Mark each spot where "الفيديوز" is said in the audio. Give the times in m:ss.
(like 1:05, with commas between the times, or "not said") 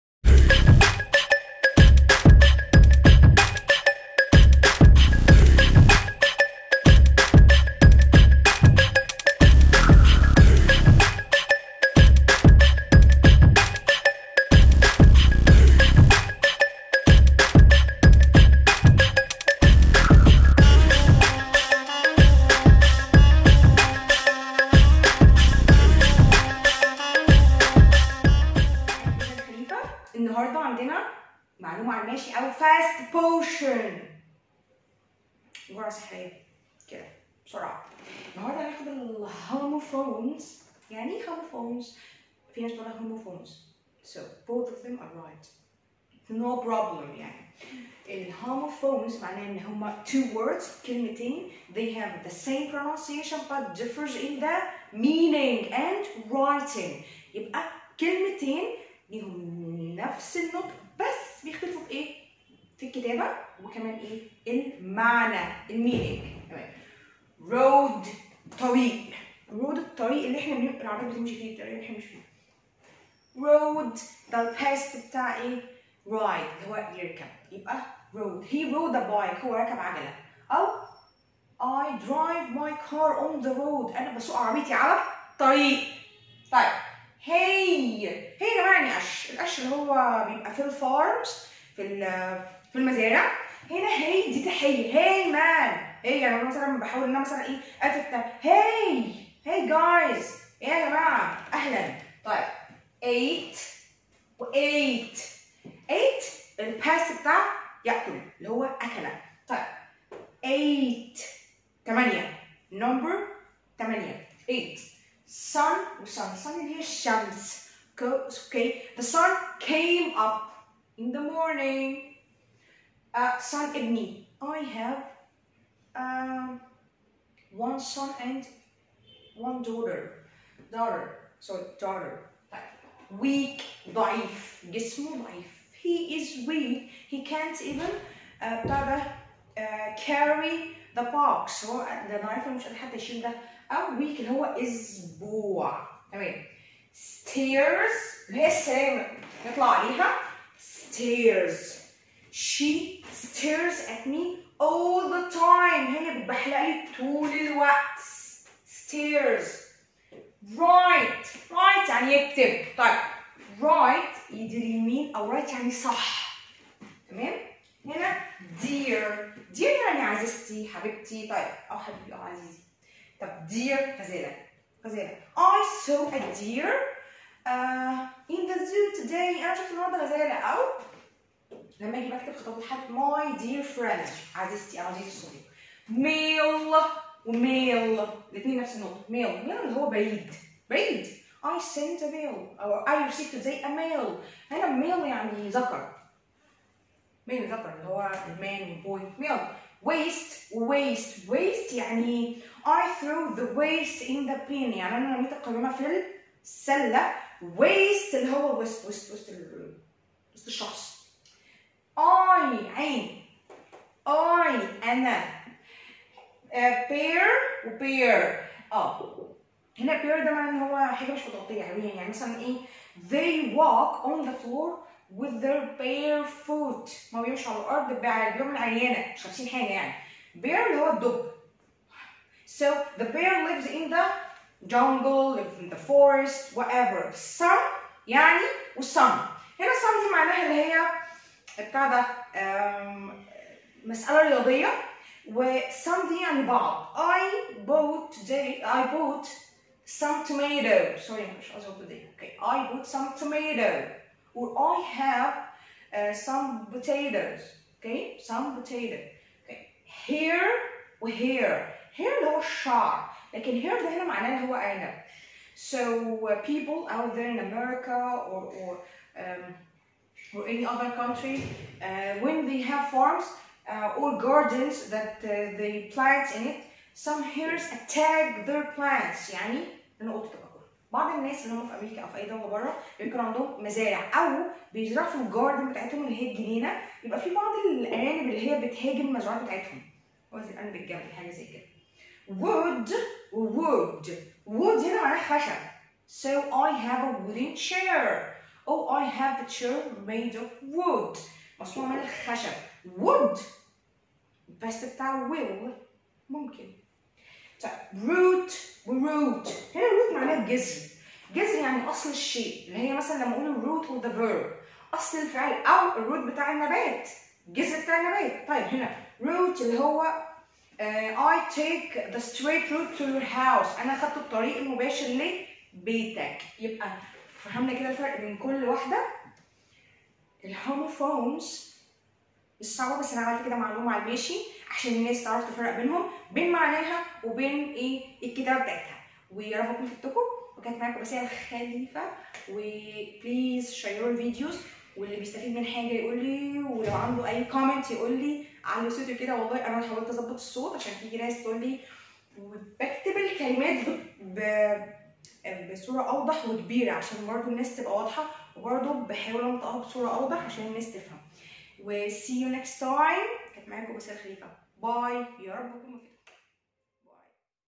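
5:44.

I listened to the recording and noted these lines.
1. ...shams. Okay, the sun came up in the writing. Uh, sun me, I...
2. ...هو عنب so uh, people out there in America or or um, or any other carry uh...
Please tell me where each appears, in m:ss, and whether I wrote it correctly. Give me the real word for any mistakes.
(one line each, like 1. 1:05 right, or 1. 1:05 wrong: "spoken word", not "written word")
1. 1:56 wrong: "morning", not "writing"
2. 4:24 wrong: "country", not "carry".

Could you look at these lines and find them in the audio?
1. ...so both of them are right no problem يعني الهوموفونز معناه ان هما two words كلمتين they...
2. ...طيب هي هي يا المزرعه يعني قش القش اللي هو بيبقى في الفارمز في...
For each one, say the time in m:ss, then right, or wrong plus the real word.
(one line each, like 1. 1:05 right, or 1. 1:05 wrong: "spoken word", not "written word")
1. 0:44 right
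2. 1:26 wrong: "جماعه", not "المزرعه".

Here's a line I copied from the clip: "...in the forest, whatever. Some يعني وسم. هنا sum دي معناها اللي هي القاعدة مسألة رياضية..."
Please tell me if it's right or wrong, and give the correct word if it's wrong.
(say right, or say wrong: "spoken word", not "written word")
right.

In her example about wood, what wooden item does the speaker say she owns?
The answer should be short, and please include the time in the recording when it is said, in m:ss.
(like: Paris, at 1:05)
a chair, at 4:57.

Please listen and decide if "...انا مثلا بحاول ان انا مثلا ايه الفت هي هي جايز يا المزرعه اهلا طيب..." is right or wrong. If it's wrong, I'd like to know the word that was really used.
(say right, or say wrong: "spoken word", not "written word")
wrong: "جماعه", not "المزرعه".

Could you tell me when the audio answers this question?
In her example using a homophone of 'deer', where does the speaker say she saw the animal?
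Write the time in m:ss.
2:58.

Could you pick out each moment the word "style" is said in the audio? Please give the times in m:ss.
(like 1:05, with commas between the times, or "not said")
not said.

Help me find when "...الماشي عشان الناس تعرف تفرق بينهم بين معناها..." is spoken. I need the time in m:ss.
5:34.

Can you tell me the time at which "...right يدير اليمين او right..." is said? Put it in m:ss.
2:43.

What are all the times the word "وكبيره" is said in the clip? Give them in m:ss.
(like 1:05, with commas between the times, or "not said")
5:56.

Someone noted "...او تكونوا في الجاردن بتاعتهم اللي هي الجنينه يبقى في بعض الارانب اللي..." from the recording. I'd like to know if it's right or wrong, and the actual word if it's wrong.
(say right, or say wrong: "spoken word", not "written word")
wrong: "بيزرعوا", not "تكونوا".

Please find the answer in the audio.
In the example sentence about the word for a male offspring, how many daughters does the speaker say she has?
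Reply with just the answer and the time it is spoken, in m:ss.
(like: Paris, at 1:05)
1, at 2:09.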